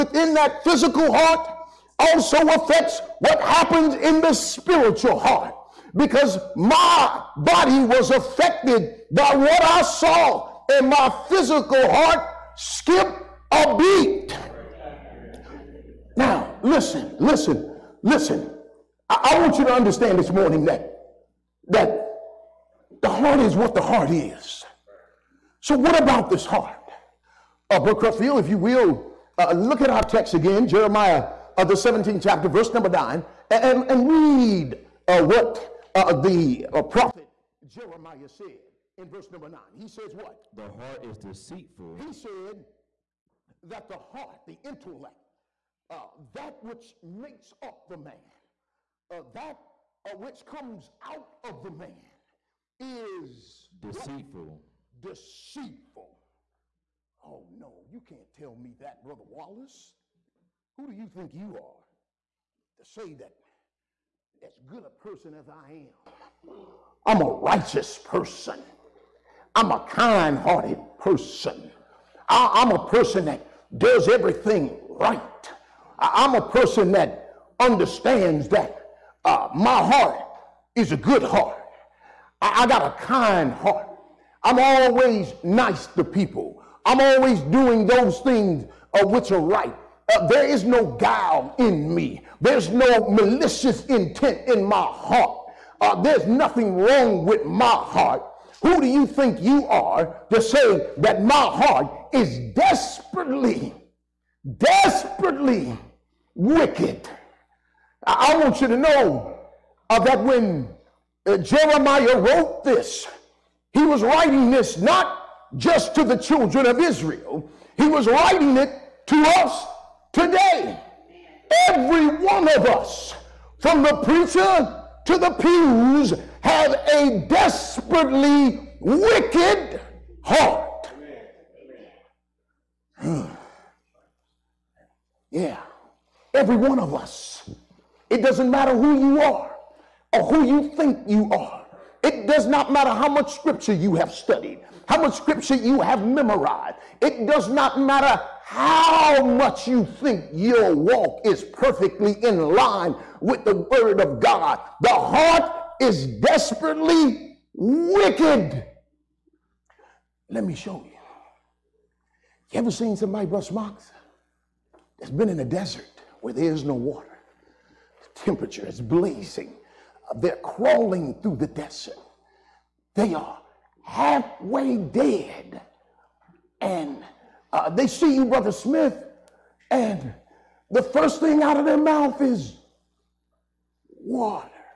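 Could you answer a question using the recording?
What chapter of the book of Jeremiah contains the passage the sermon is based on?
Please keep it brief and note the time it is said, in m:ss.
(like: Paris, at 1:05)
17, at 0:31.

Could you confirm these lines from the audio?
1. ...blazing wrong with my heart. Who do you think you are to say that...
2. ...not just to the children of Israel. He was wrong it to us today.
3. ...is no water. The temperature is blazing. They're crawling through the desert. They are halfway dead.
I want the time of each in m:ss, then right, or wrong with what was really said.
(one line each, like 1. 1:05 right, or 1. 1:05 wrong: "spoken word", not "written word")
1. 1:36 wrong: "nothing", not "blazing"
2. 1:54 wrong: "writing", not "wrong"
3. 2:46 right.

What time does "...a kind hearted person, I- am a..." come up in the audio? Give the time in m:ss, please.
1:09.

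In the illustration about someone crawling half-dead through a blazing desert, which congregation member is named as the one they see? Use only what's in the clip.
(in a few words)
Brother Smith.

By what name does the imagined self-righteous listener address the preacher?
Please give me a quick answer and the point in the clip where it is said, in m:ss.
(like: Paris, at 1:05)
Brother Wallace, at 0:59.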